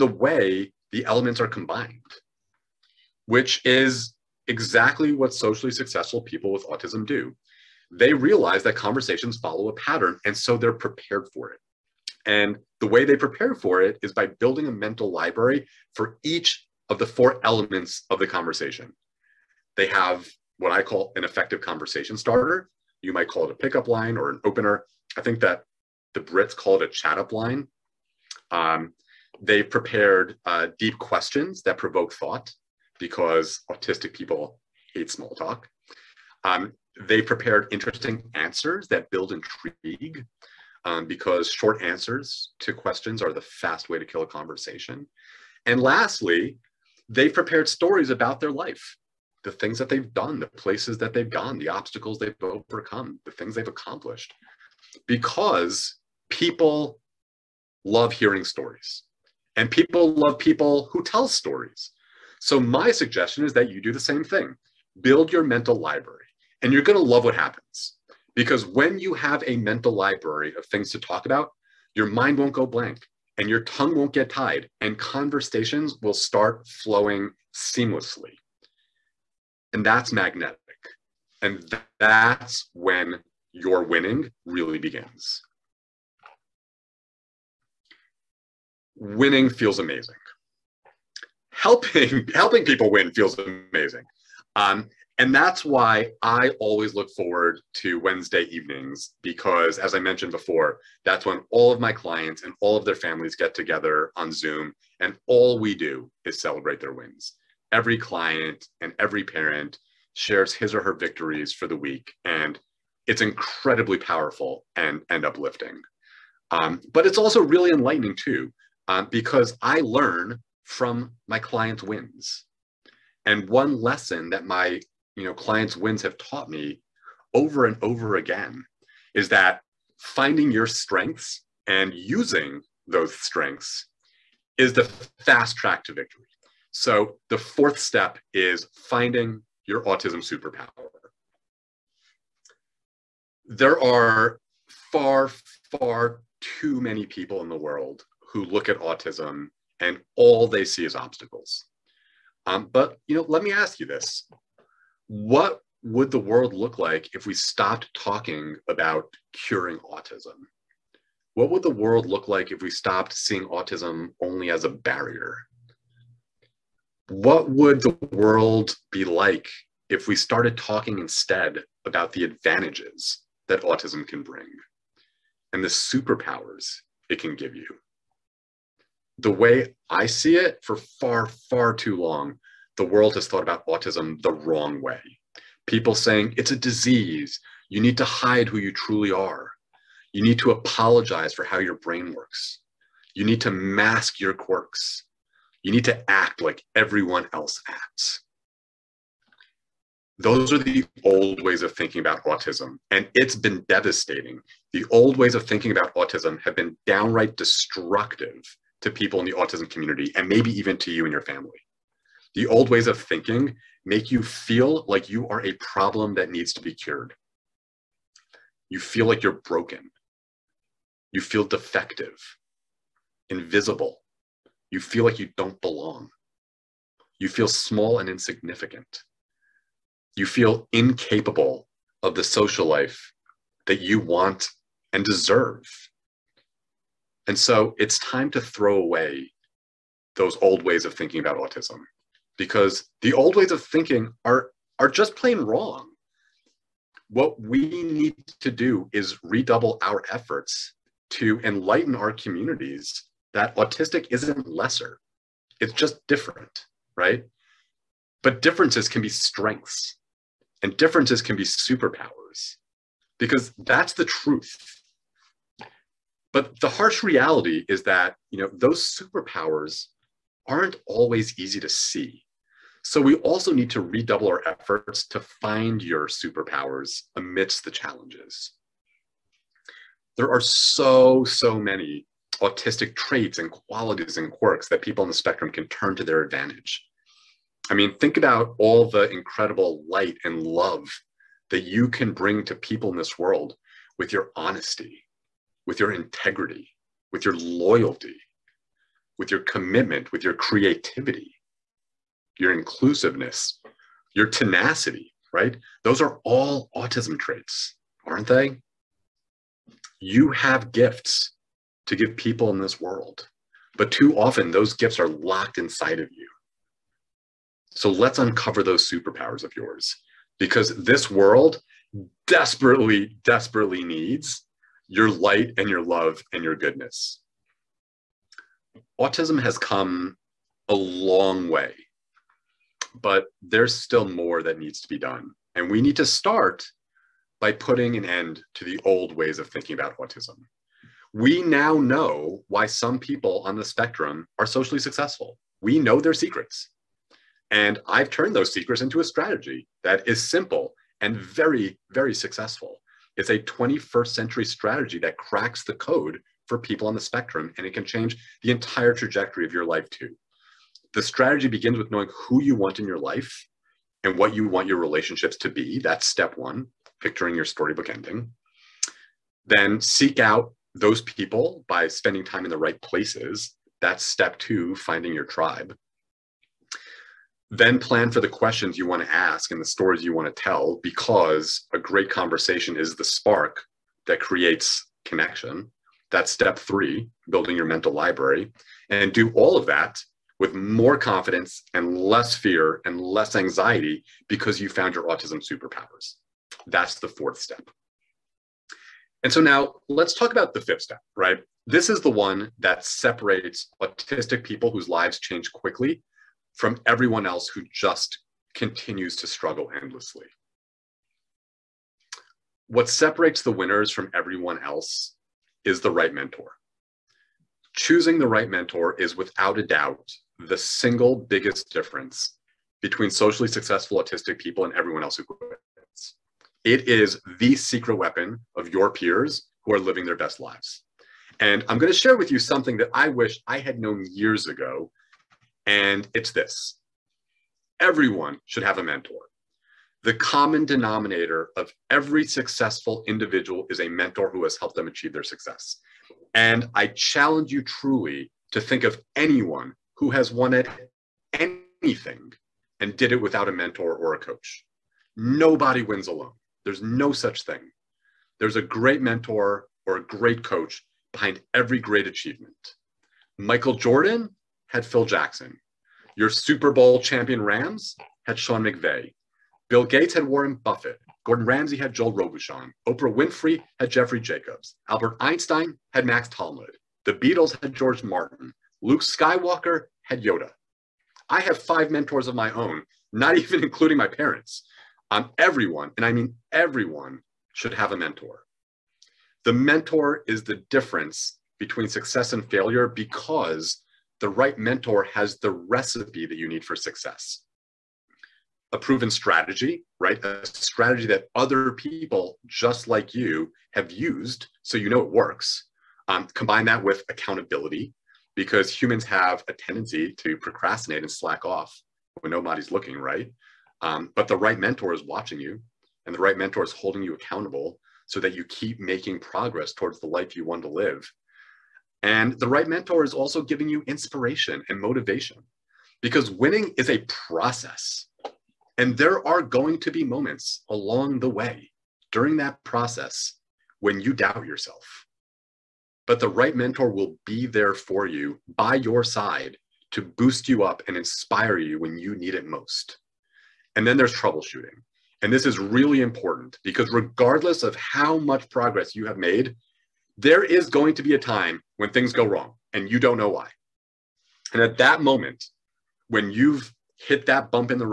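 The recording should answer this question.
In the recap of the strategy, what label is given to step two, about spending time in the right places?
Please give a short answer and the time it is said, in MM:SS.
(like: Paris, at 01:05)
finding your tribe, at 06:14.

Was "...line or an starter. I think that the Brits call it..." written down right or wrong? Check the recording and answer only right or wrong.
wrong.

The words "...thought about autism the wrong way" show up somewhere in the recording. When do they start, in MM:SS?
03:03.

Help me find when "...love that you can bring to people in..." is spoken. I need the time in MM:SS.
04:50.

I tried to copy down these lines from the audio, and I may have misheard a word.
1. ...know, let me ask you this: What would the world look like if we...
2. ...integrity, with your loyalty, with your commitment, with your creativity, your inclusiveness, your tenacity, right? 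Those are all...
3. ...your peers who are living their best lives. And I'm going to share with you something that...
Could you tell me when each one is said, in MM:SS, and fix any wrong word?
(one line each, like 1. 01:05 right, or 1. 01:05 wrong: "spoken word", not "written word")
1. 02:33 right
2. 04:55 right
3. 07:08 right.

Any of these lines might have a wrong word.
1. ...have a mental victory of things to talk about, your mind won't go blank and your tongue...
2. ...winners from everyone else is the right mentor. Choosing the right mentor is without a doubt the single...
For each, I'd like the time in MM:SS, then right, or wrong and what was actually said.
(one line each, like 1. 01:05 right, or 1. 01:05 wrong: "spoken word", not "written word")
1. 01:09 wrong: "library", not "victory"
2. 06:53 right.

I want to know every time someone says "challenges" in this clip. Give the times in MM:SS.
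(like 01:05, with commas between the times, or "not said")
04:37, 07:26.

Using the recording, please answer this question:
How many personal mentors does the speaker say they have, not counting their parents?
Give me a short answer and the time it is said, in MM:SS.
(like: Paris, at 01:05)
5, at 08:01.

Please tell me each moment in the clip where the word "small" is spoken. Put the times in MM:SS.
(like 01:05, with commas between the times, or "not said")
00:35, 03:47.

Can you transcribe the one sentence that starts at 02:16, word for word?
So the fourth step is finding your autism superpower.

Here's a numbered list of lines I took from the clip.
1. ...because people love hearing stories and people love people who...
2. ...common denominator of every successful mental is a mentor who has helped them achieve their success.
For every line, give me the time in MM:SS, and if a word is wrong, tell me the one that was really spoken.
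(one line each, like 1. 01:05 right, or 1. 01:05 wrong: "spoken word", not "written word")
1. 00:55 right
2. 07:20 wrong: "individual", not "mental".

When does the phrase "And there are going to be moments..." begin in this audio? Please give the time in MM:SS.
08:48.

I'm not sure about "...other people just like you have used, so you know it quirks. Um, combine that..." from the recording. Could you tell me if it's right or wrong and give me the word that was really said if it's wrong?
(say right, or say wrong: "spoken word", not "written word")
wrong: "works", not "quirks".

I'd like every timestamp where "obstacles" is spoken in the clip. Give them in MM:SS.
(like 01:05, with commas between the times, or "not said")
00:51, 02:30.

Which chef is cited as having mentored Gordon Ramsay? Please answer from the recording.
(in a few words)
Joel Robuchon.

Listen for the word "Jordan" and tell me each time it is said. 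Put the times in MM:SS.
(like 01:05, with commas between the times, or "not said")
07:43.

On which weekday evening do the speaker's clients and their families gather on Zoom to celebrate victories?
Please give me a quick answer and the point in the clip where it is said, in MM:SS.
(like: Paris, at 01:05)
Wednesday, at 01:37.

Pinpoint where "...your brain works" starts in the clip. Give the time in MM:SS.
03:11.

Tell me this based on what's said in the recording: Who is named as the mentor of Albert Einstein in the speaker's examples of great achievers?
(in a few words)
Max Talmud.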